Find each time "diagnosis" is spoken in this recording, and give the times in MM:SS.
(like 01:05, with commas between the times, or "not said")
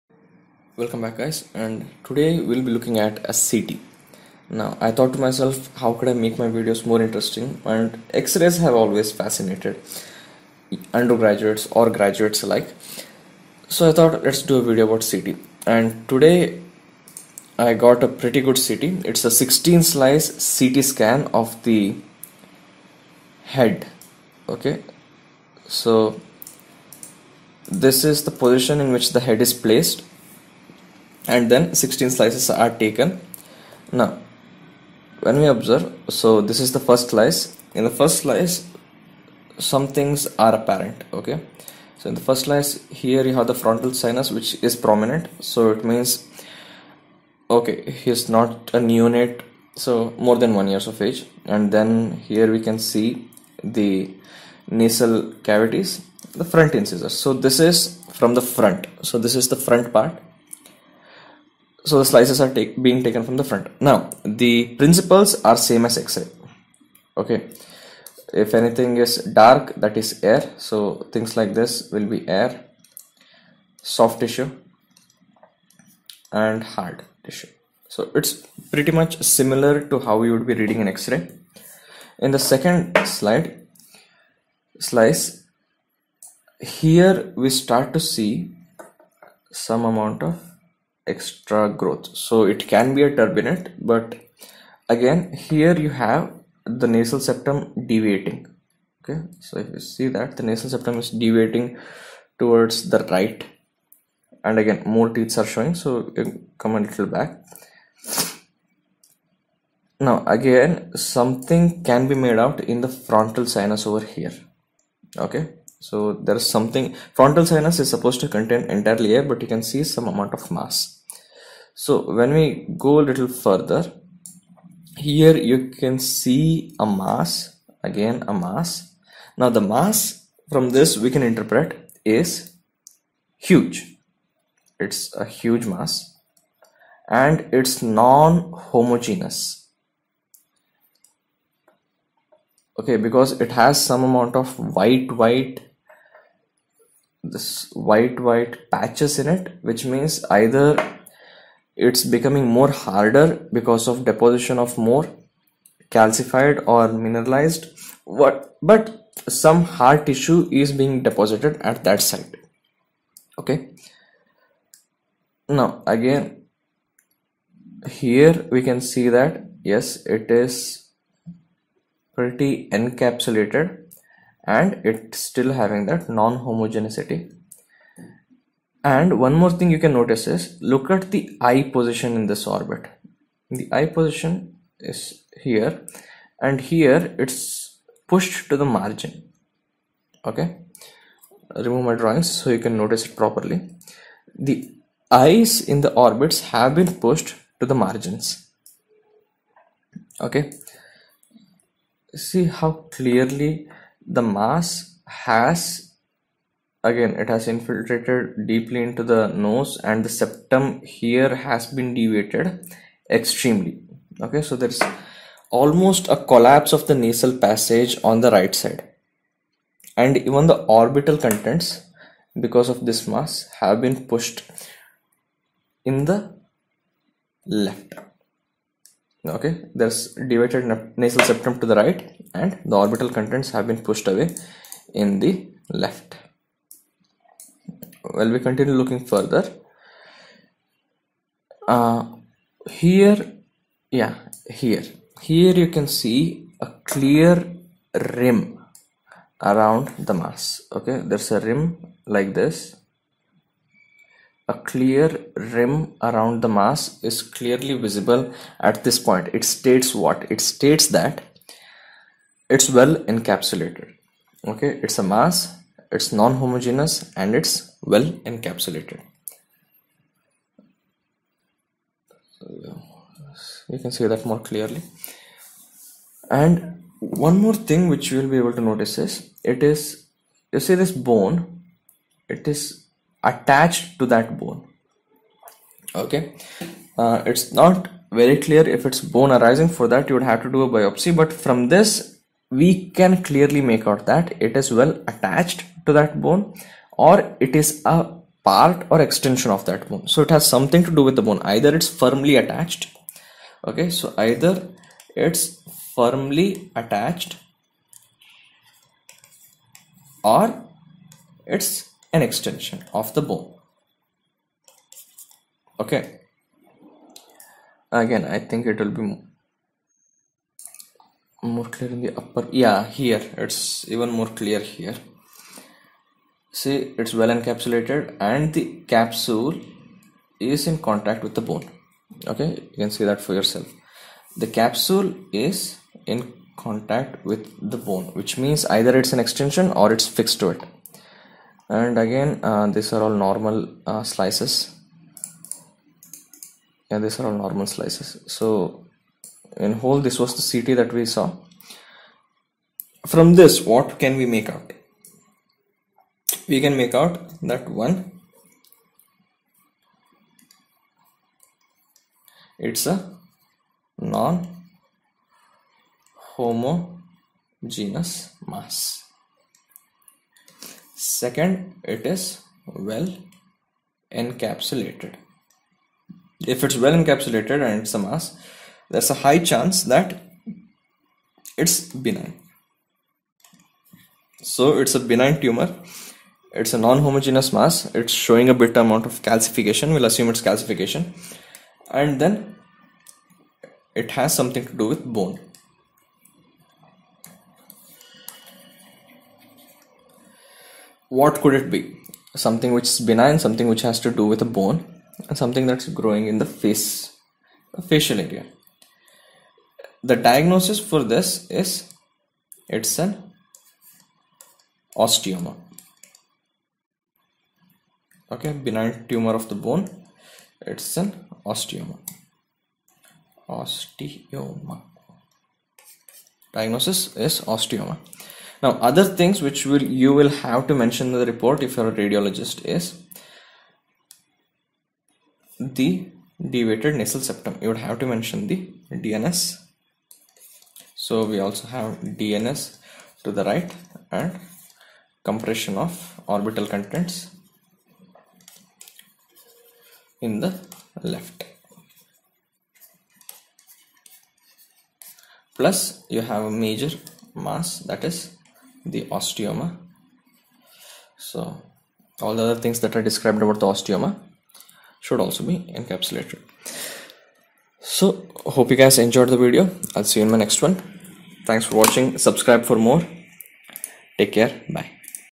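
06:50, 07:06.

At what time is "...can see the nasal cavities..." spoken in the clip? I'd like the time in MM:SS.
00:52.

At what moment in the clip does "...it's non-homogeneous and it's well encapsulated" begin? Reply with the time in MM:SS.
04:25.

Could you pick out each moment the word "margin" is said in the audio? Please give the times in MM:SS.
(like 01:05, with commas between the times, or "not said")
03:08, 03:17.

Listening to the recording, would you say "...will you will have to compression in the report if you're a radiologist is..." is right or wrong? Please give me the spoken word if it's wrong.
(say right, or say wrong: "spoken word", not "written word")
wrong: "mention", not "compression".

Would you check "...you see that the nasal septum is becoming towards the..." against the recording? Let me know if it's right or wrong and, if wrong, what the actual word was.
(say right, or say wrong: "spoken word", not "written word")
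wrong: "deviating", not "becoming".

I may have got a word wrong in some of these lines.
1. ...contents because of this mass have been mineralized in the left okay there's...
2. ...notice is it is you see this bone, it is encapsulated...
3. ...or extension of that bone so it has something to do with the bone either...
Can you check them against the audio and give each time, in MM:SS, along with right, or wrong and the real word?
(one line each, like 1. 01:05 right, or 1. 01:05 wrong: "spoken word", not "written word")
1. 03:41 wrong: "pushed", not "mineralized"
2. 04:38 wrong: "attached", not "encapsulated"
3. 04:58 right.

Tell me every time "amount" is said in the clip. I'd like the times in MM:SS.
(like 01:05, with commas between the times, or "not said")
01:29, 02:00, 02:24, 06:28.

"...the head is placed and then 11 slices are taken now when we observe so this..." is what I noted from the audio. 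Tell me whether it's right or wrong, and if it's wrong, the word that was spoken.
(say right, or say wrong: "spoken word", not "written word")
wrong: "16", not "11".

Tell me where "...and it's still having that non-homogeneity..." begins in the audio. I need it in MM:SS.
02:54.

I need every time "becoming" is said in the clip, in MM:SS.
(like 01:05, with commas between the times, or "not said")
02:32.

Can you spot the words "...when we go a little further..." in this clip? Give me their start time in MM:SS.
02:02.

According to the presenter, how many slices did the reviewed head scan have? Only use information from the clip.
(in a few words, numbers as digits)
16.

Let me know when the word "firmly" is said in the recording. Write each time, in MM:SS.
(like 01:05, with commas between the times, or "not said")
05:01, 05:05.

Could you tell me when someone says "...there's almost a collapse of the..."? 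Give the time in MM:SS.
03:34.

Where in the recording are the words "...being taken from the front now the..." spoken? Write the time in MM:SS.
01:02.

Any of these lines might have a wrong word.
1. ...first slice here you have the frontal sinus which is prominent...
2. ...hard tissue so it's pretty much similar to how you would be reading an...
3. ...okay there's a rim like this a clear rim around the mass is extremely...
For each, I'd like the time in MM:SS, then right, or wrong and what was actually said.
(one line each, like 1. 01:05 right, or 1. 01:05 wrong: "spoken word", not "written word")
1. 00:42 right
2. 01:16 right
3. 04:10 wrong: "clearly", not "extremely".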